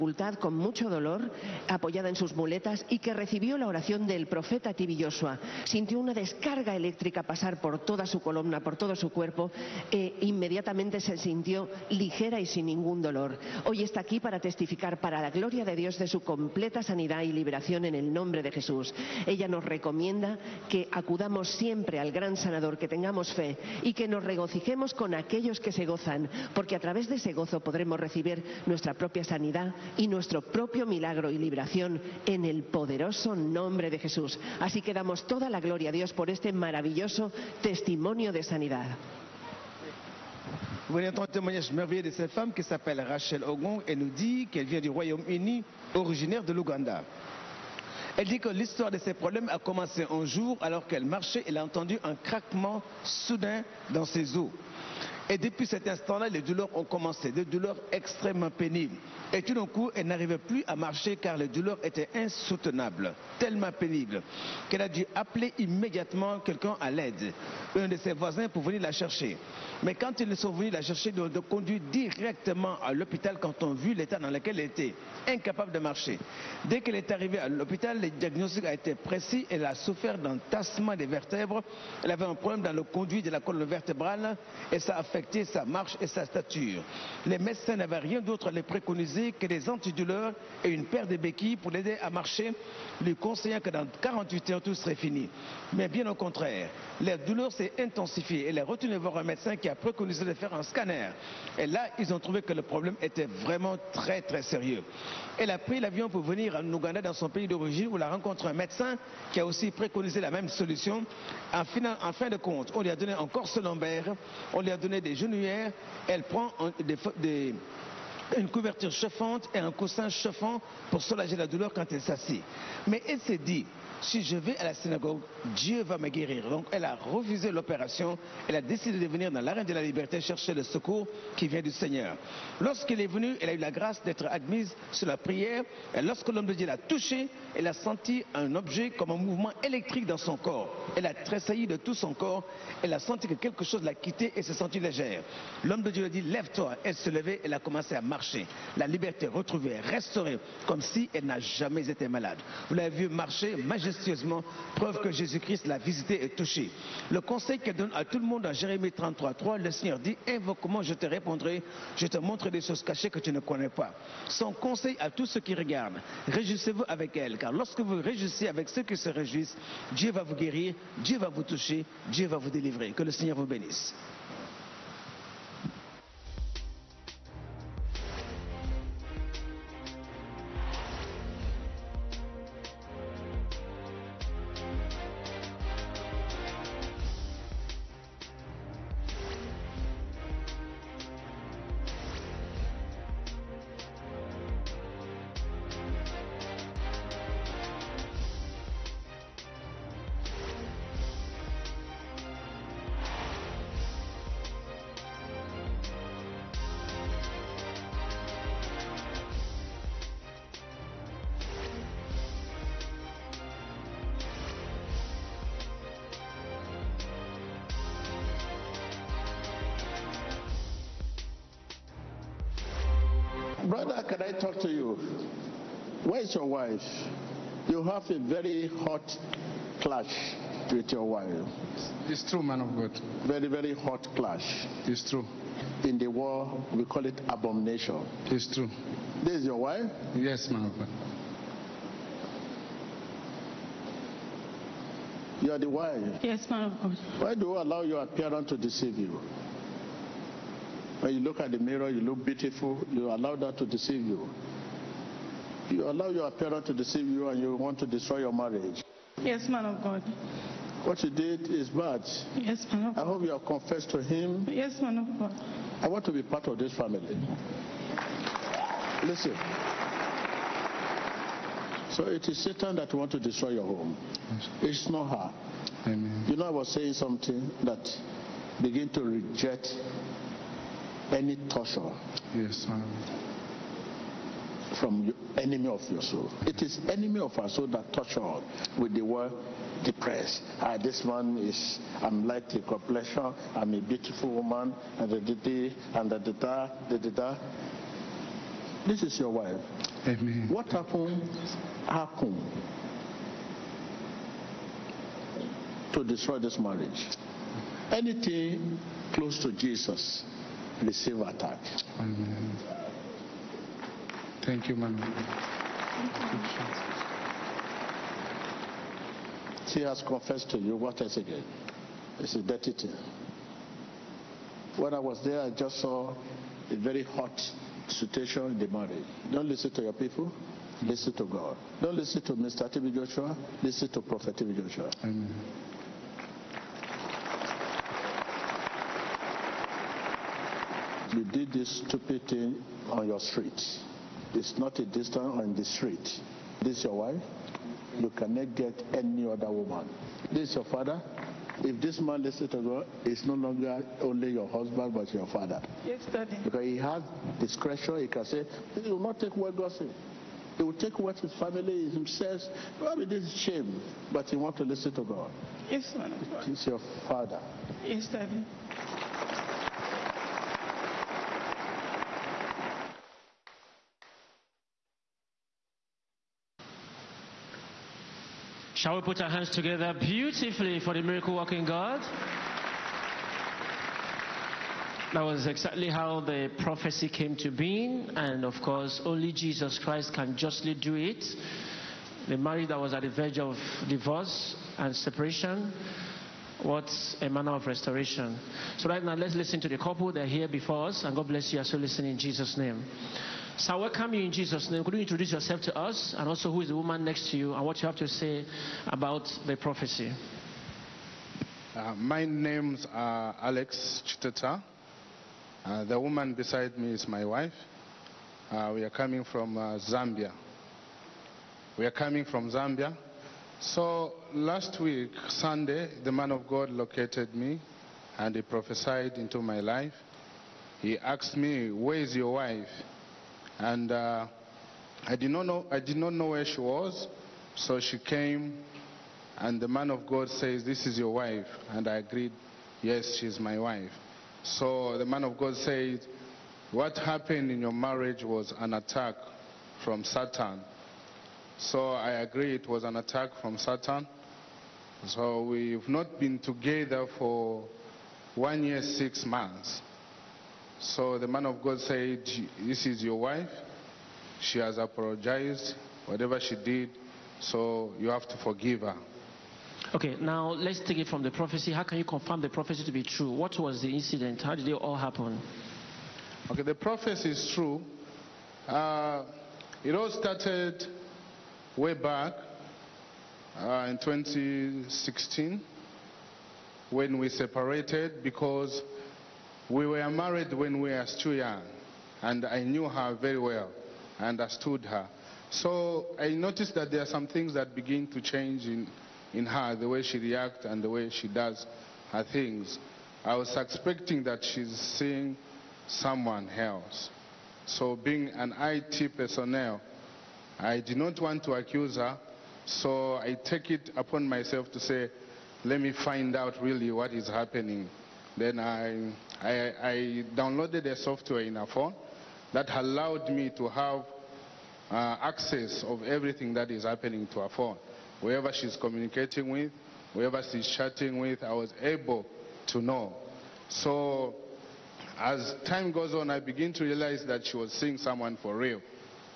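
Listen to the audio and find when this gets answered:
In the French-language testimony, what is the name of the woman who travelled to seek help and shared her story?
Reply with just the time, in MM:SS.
00:43.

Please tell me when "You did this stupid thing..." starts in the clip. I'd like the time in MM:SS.
05:41.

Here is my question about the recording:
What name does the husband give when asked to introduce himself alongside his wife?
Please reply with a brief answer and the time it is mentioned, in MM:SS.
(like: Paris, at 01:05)
Alex Chiteta, at 06:53.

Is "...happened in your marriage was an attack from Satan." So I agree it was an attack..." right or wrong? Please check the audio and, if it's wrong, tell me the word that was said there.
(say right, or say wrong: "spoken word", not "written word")
right.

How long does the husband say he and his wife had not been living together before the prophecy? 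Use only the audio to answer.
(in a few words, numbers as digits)
1 year, 6 months.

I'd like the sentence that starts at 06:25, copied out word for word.
That was exactly how the prophecy came to being, and of course, only Jesus Christ can justly do it.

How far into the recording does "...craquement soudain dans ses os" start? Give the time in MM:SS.
00:52.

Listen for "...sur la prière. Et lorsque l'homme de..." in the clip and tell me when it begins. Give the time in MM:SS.
02:14.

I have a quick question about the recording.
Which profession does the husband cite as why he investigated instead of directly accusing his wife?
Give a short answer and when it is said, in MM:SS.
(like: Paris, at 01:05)
IT personnel, at 08:28.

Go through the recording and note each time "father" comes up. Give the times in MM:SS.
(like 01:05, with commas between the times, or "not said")
05:50, 05:55, 06:07.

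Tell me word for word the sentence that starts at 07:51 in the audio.
How can you confirm the prophecy to be true?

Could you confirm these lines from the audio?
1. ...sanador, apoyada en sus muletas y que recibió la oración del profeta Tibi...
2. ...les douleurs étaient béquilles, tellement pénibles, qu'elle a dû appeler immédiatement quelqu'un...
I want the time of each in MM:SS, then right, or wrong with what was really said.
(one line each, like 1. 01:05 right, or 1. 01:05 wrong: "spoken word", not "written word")
1. 00:00 wrong: "dolor", not "sanador"
2. 01:01 wrong: "insoutenables", not "béquilles".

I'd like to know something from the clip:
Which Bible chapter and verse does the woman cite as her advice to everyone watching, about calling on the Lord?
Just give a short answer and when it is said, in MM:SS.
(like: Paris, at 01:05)
Jeremiah 33:3, at 02:38.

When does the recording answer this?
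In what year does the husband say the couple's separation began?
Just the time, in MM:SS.
08:03.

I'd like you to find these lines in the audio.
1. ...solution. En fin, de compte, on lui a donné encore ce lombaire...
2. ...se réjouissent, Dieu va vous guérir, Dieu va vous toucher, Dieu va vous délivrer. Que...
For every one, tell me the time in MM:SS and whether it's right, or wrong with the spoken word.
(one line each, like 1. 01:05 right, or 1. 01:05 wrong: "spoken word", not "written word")
1. 01:50 right
2. 02:48 right.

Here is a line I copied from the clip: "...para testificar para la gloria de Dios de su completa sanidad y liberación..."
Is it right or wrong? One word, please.
right.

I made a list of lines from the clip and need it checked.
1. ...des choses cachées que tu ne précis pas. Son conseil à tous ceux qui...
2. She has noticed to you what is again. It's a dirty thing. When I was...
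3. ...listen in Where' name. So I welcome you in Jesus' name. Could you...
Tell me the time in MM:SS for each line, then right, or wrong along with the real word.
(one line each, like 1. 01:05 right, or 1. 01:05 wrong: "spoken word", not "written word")
1. 02:42 wrong: "connais", not "précis"
2. 05:19 wrong: "confessed", not "noticed"
3. 06:41 wrong: "Jesus", not "Where".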